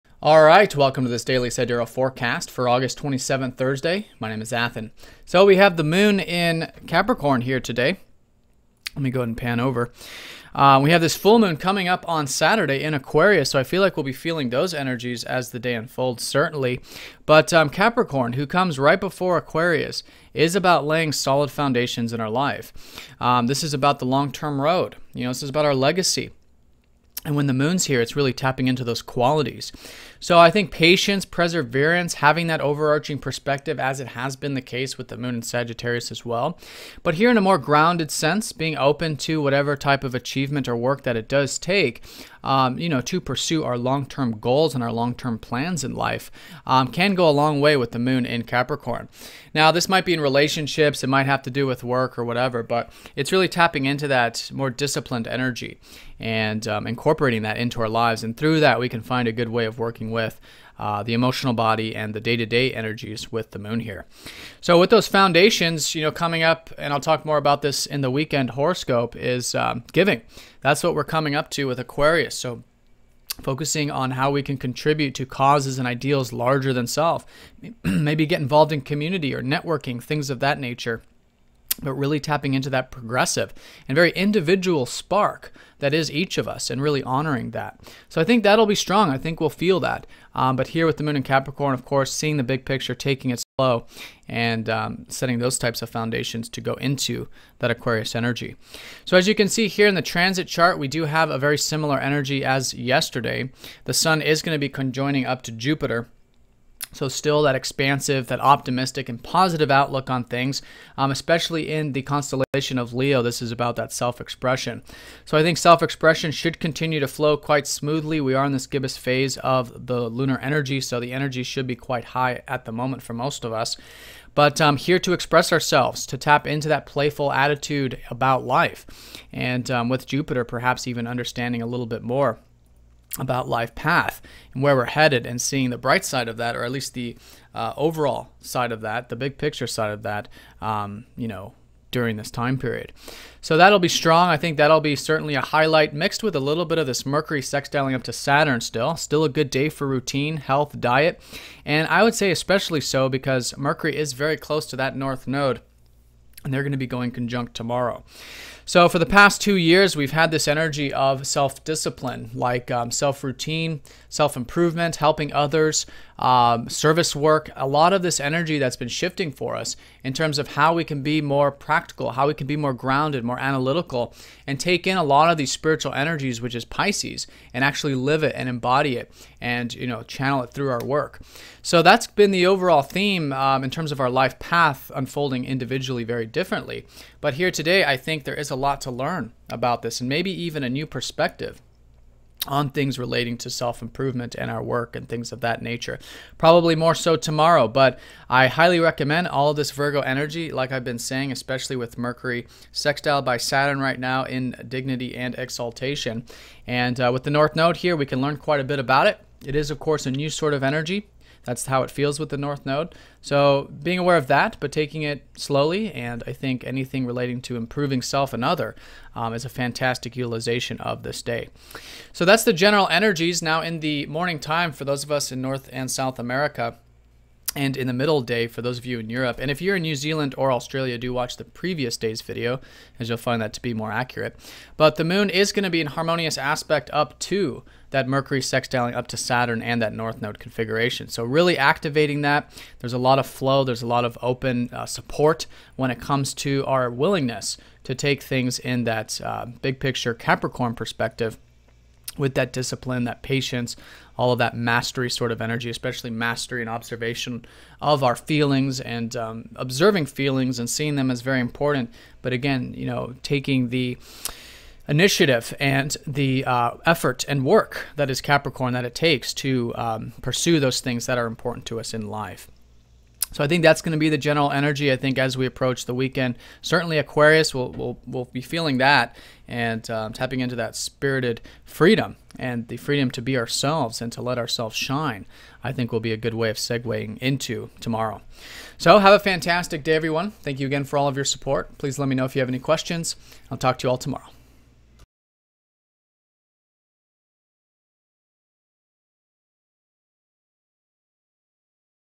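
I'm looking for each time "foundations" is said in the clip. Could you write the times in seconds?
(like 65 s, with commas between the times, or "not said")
21 s, 65 s, 95 s.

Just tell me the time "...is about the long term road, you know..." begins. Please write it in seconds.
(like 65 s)
23 s.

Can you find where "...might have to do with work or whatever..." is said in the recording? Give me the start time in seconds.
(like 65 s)
51 s.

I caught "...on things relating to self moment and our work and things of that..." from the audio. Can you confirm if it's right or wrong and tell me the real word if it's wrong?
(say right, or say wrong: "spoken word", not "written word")
wrong: "improvement", not "moment".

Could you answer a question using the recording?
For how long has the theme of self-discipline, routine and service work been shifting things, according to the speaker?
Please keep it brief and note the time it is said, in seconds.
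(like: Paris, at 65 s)
2 years, at 159 s.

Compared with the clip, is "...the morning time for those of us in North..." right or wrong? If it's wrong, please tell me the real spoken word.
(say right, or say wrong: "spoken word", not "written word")
right.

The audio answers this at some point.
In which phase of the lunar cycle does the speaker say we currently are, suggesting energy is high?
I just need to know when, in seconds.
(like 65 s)
118 s.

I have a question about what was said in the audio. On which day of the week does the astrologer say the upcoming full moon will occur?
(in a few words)
Saturday.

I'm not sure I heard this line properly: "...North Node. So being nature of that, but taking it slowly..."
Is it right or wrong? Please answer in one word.
wrong.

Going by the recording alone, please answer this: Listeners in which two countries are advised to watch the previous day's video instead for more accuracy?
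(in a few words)
New Zealand or Australia.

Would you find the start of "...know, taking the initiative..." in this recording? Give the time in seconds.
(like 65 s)
262 s.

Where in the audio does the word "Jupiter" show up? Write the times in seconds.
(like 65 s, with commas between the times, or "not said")
105 s, 130 s.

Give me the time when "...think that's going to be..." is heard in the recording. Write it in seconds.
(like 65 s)
273 s.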